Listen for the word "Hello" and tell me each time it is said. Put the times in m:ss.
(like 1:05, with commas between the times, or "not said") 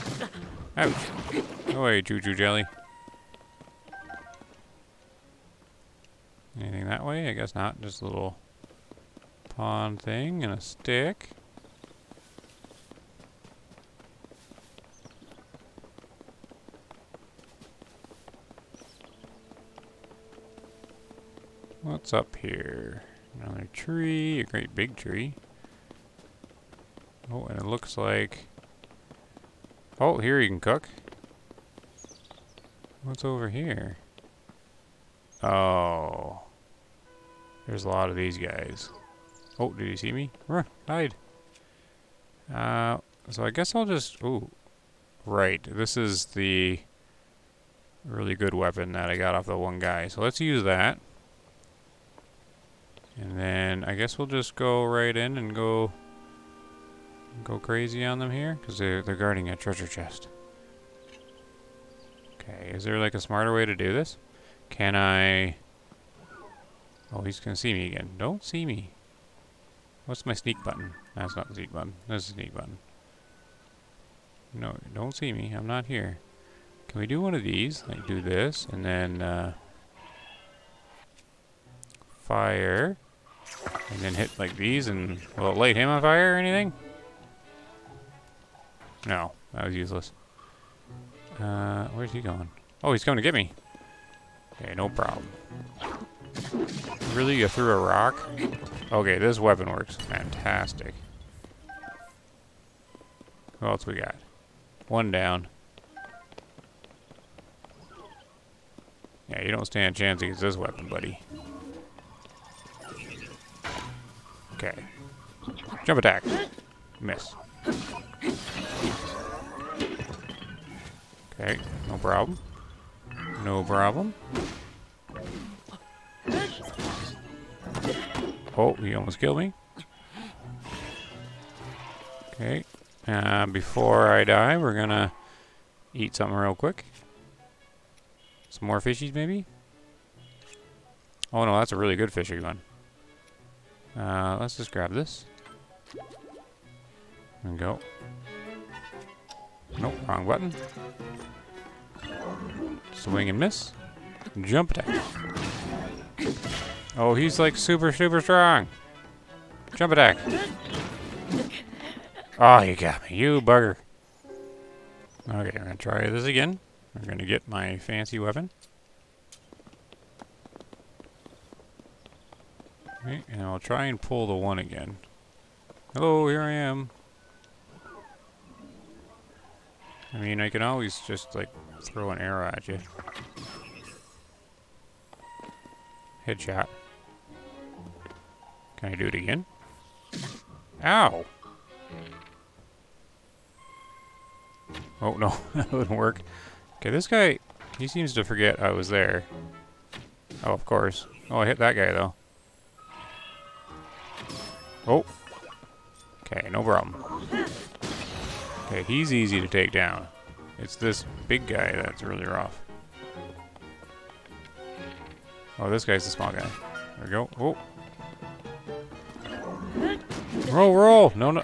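2:55.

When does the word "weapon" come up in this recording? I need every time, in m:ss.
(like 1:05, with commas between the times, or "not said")
0:48, 1:39, 1:50, 2:48.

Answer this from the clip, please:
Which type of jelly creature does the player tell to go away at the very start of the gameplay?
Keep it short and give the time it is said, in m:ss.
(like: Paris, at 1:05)
Chuchu jelly, at 0:02.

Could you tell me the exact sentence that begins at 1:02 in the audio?
Okay, is there like a smarter way to do this?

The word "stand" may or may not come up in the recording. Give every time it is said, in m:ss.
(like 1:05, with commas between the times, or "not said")
1:49.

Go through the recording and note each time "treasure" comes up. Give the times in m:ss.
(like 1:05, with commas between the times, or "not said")
0:59.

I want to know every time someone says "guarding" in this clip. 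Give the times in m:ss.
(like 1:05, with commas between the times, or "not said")
0:59.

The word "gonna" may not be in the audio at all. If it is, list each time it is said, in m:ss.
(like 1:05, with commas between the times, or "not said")
1:07, 2:14.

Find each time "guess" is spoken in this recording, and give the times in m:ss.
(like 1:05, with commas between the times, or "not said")
0:07, 0:43, 0:53.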